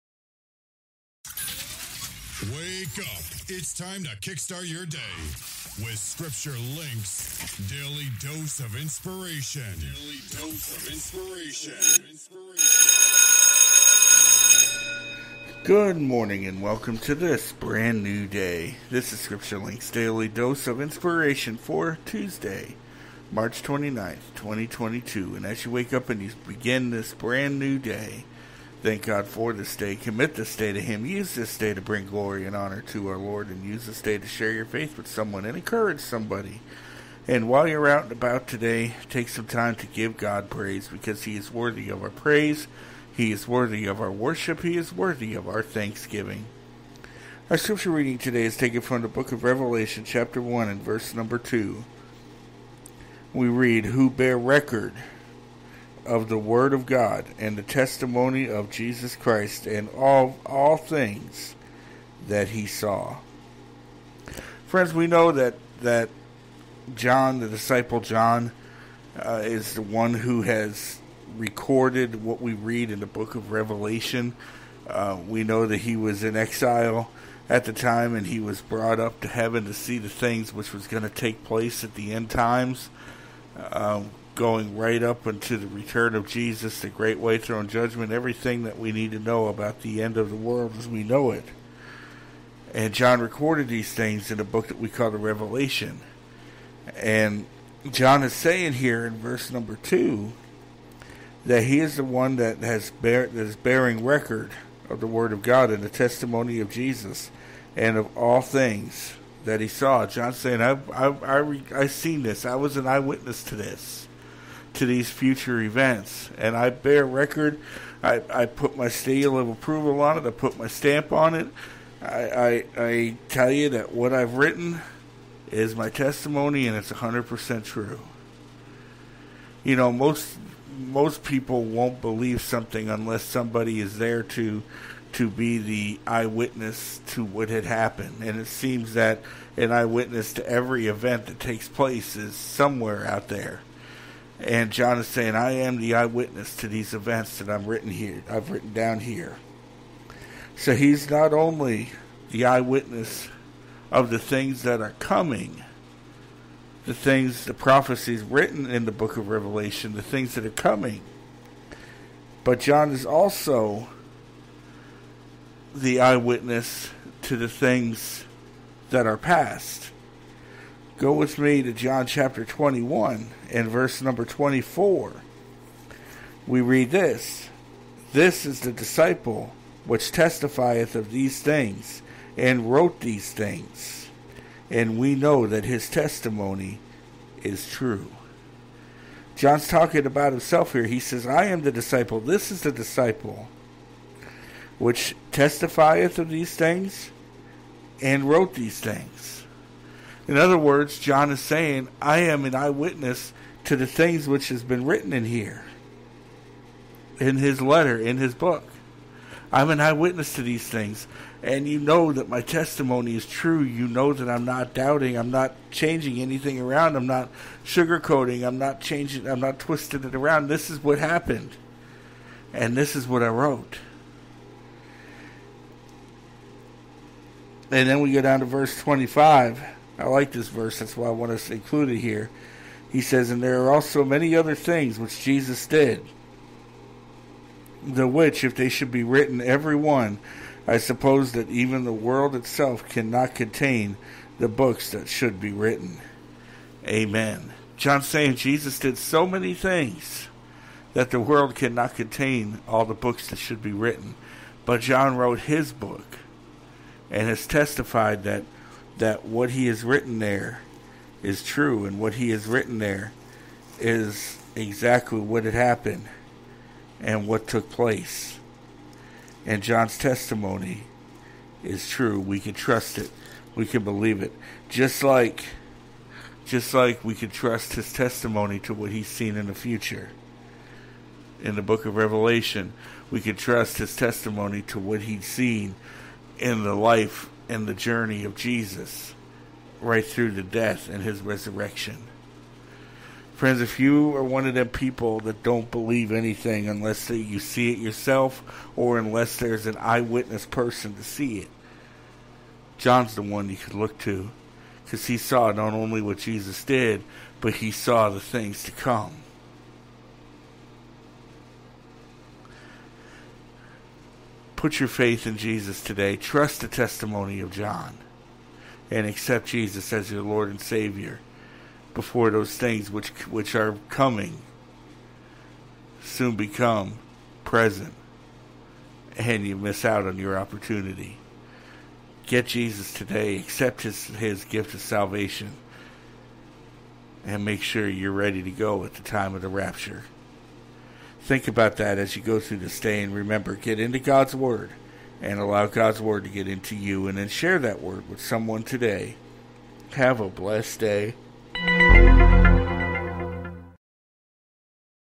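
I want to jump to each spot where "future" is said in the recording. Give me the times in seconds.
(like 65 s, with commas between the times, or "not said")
115 s, 279 s.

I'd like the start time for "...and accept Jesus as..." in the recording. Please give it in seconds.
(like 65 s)
318 s.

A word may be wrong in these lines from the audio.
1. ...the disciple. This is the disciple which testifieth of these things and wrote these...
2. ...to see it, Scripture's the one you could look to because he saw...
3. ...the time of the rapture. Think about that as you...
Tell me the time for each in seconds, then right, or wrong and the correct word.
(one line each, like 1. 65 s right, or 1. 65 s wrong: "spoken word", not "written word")
1. 191 s right
2. 300 s wrong: "John", not "Scripture"
3. 338 s right.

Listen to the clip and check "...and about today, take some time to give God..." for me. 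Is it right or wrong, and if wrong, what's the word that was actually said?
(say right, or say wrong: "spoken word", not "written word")
right.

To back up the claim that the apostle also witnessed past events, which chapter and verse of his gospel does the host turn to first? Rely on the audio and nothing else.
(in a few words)
John 21:24.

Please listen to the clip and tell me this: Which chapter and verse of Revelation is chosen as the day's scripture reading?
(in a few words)
Revelation 1:2.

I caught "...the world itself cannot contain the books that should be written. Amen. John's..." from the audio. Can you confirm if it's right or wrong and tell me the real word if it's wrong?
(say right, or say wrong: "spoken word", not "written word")
right.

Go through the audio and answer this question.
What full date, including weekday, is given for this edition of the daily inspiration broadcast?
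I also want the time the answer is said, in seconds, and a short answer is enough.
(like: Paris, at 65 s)
Tuesday, March 29th, 2022, at 22 s.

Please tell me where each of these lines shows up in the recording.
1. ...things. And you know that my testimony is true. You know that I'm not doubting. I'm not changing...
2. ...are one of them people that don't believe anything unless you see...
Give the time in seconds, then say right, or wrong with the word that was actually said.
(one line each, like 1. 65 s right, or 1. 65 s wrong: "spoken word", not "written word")
1. 210 s right
2. 294 s right.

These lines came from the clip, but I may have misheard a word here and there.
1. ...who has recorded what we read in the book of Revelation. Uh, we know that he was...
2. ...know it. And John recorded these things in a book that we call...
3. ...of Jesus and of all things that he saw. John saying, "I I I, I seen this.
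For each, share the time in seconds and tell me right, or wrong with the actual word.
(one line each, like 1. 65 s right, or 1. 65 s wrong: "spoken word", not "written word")
1. 70 s right
2. 91 s right
3. 106 s right.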